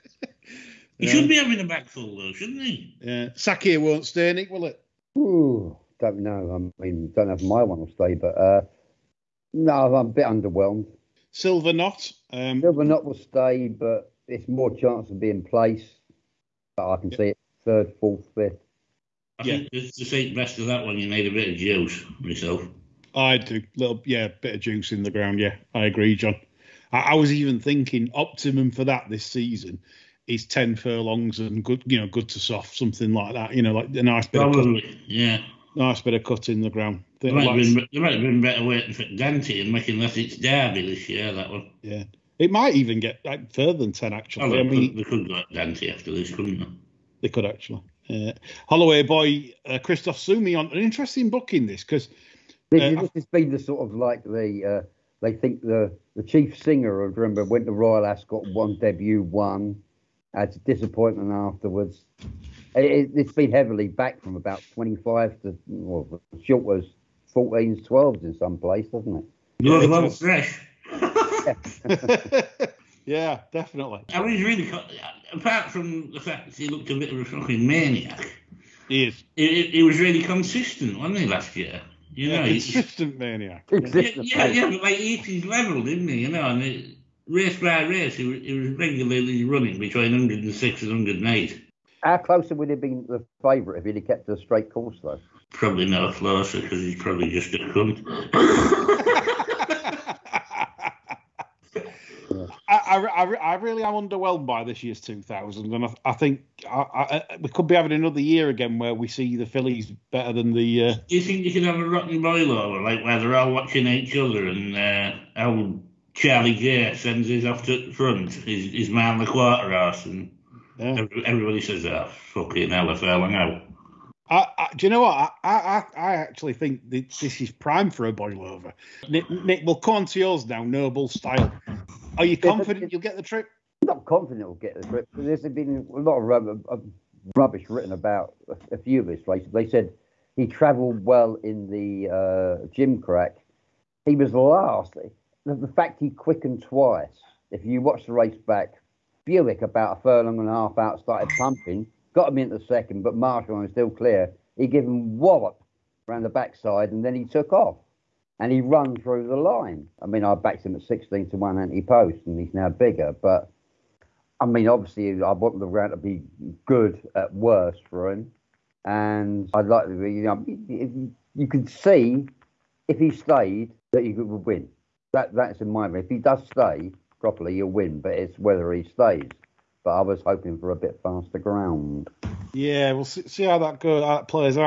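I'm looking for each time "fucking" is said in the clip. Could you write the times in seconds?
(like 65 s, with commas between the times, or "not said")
77 s, 122 s.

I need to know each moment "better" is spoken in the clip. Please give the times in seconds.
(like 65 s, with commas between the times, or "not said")
38 s, 110 s.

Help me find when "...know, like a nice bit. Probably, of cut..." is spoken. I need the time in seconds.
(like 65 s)
33 s.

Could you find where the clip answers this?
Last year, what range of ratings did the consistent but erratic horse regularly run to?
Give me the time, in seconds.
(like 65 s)
89 s.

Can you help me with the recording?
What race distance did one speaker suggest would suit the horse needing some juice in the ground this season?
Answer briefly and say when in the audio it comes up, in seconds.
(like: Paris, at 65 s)
10 furlongs, at 30 s.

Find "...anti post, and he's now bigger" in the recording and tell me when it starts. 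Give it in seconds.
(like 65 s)
161 s.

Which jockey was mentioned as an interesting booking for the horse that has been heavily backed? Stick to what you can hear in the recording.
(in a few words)
Christophe Soumillon.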